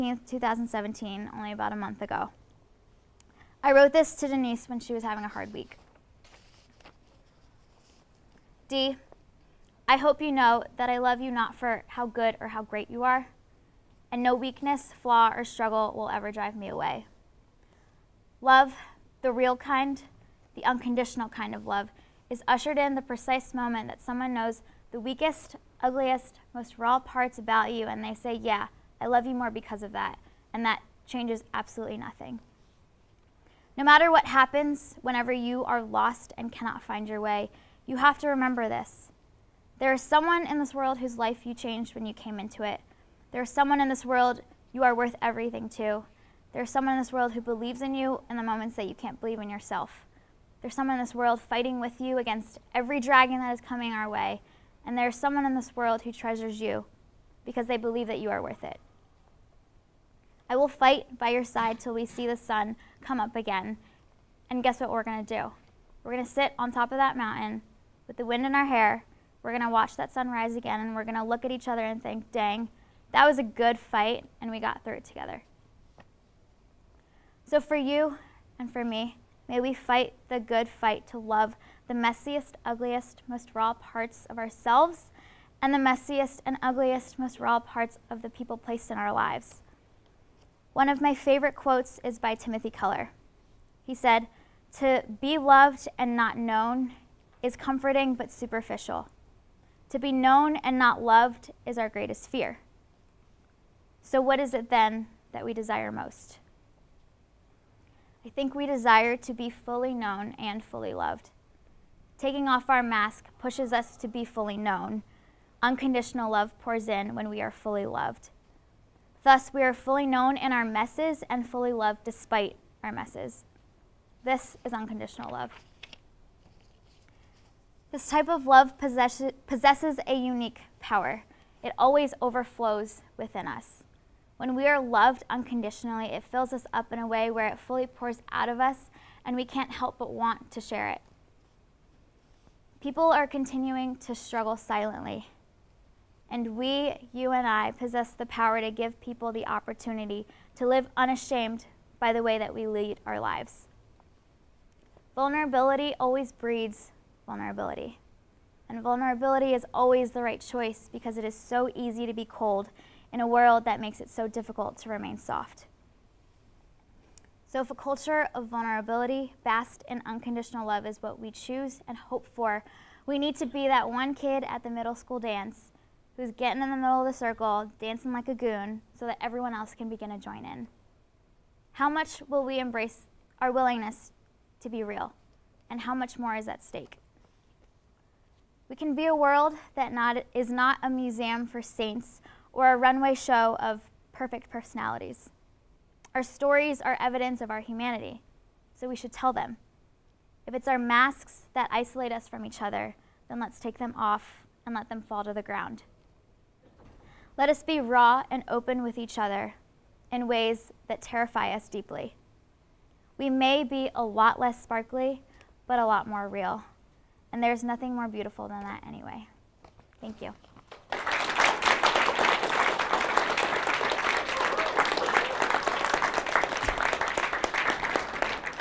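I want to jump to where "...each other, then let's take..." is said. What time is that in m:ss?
3:22.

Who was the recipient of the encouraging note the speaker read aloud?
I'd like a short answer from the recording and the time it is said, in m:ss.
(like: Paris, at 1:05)
Denise, at 0:04.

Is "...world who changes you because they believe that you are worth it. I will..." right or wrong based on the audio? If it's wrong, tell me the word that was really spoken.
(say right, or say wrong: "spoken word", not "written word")
wrong: "treasures", not "changes".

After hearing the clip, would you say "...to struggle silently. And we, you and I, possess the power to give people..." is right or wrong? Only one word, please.
right.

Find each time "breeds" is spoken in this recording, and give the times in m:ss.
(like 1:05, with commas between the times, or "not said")
2:36.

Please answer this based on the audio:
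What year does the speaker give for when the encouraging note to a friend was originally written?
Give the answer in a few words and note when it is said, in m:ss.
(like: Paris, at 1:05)
2017, at 0:00.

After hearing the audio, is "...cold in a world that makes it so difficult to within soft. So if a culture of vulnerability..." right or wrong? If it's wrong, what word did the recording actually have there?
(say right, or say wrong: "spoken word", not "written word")
wrong: "remain", not "within".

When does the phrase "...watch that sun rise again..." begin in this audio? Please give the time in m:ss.
1:09.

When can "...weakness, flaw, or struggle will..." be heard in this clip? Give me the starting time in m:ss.
0:14.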